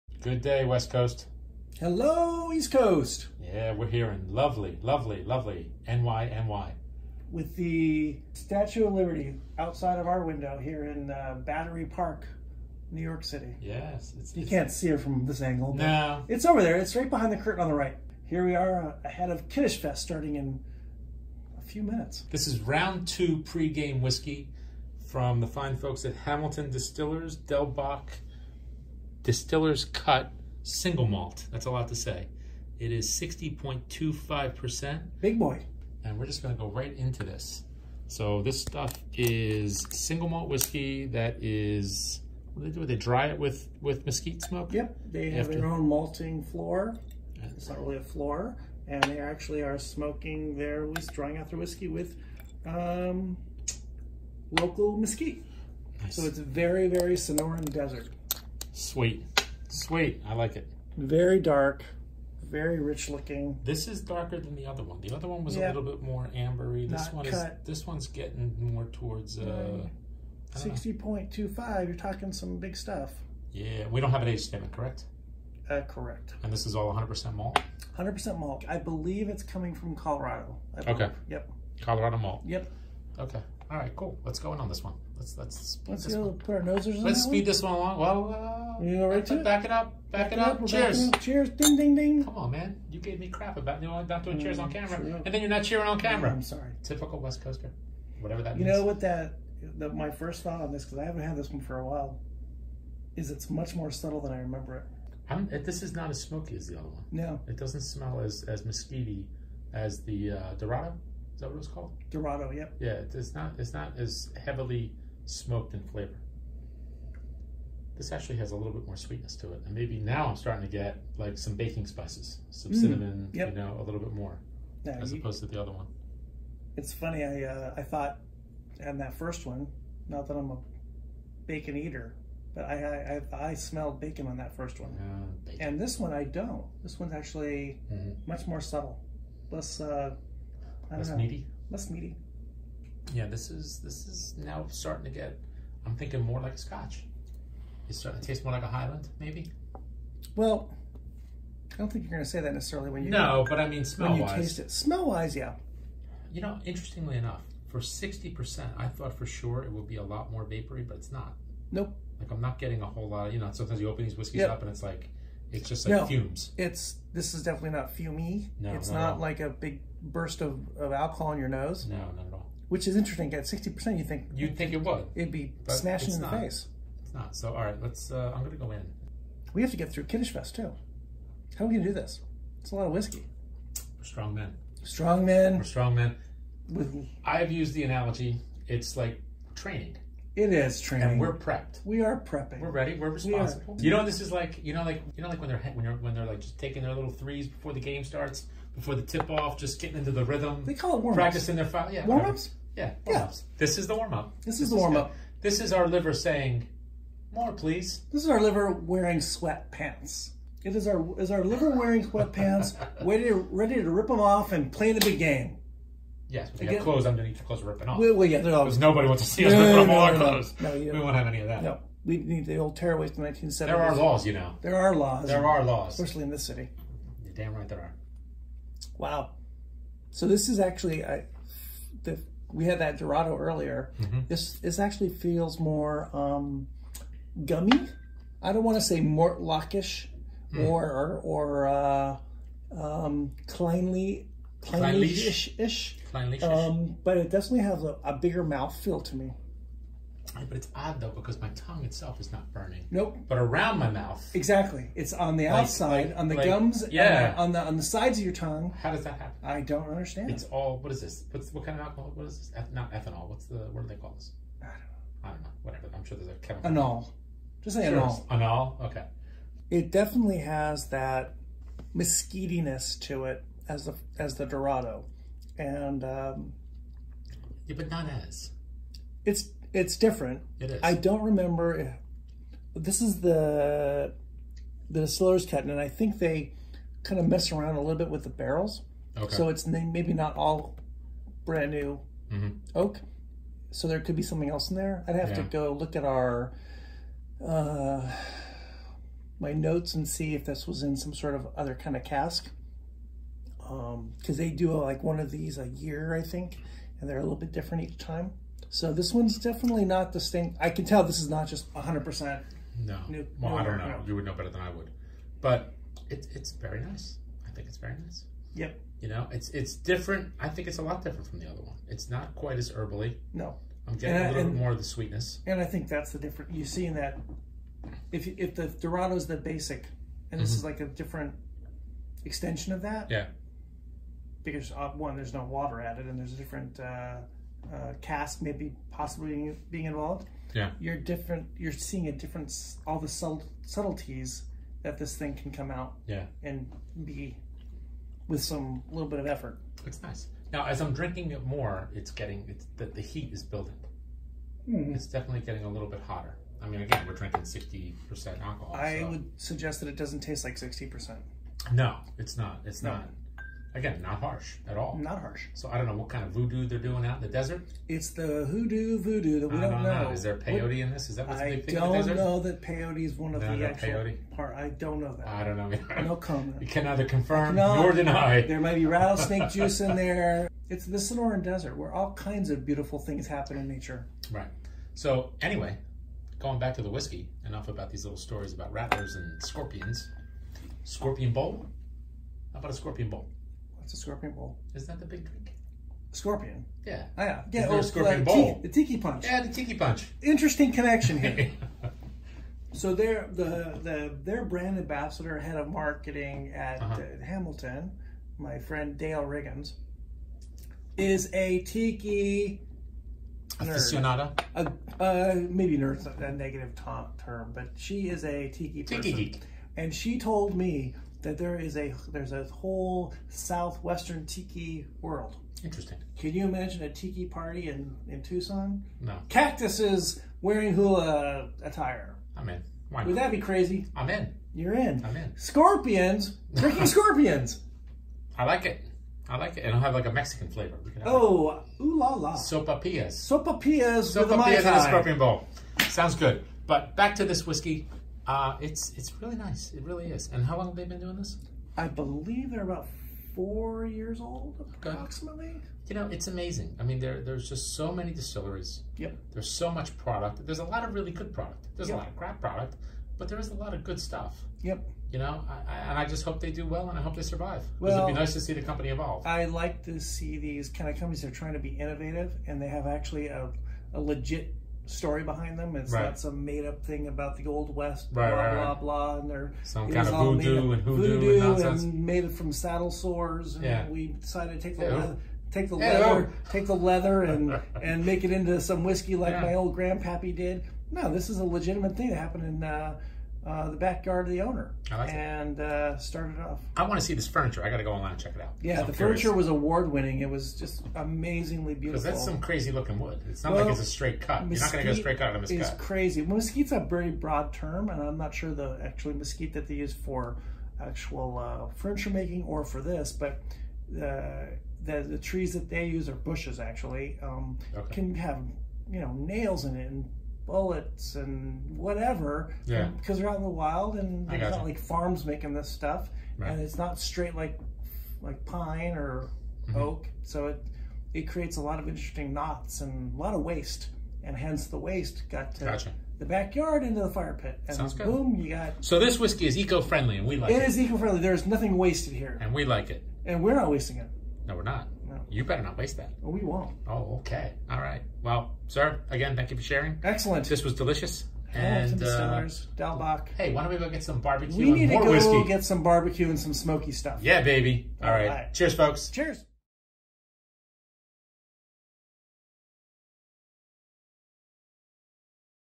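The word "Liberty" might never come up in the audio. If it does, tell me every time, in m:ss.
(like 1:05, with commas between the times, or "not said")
0:08.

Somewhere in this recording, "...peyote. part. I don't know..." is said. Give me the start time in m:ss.
6:13.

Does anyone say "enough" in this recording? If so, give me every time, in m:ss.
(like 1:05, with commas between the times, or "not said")
2:37, 6:27.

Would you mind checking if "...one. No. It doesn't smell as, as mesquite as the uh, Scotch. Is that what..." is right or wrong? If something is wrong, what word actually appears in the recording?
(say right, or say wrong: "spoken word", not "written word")
wrong: "Dorado", not "Scotch".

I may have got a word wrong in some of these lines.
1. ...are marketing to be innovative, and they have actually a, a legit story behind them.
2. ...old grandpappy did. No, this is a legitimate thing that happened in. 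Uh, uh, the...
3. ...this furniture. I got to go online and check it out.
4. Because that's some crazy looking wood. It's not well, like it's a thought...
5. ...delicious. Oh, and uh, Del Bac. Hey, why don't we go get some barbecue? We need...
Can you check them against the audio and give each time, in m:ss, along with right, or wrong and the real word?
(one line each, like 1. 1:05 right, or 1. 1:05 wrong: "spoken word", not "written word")
1. 7:51 wrong: "trying", not "marketing"
2. 8:09 right
3. 8:17 right
4. 8:22 wrong: "straight", not "thought"
5. 9:10 right.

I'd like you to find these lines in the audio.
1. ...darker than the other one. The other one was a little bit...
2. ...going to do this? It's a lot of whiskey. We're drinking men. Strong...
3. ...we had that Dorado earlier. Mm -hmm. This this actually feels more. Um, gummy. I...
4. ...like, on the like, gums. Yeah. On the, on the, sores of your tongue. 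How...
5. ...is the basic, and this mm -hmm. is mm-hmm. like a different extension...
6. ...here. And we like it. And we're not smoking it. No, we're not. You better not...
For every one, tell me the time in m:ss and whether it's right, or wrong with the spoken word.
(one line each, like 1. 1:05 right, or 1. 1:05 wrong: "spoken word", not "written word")
1. 1:04 right
2. 3:01 wrong: "strong", not "drinking"
3. 3:52 right
4. 4:16 wrong: "sides", not "sores"
5. 5:29 right
6. 9:02 wrong: "wasting", not "smoking".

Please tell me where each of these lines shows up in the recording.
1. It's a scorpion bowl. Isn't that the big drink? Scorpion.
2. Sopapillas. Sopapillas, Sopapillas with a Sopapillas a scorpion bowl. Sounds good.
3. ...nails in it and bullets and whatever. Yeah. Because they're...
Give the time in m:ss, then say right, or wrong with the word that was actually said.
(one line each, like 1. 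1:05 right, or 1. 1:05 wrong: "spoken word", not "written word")
1. 6:33 right
2. 7:22 right
3. 8:39 right.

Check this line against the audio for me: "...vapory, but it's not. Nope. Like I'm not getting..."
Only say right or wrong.
right.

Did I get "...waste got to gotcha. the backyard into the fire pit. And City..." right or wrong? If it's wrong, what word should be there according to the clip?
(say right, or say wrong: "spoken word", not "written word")
wrong: "Sounds", not "City".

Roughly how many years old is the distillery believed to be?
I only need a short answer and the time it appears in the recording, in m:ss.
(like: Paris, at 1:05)
4, at 7:33.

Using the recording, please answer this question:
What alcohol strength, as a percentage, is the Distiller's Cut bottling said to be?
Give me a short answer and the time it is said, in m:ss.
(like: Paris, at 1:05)
60.25%, at 0:33.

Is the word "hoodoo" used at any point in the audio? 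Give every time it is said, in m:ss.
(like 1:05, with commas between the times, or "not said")
6:08, 8:00.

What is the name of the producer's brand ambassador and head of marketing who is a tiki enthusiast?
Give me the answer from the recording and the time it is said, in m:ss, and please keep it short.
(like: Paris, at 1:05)
Dale Riggins, at 6:48.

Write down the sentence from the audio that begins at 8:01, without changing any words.
And made it from saddle sores.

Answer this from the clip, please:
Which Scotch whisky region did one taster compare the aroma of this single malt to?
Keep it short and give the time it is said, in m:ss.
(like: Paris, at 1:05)
Highland, at 2:28.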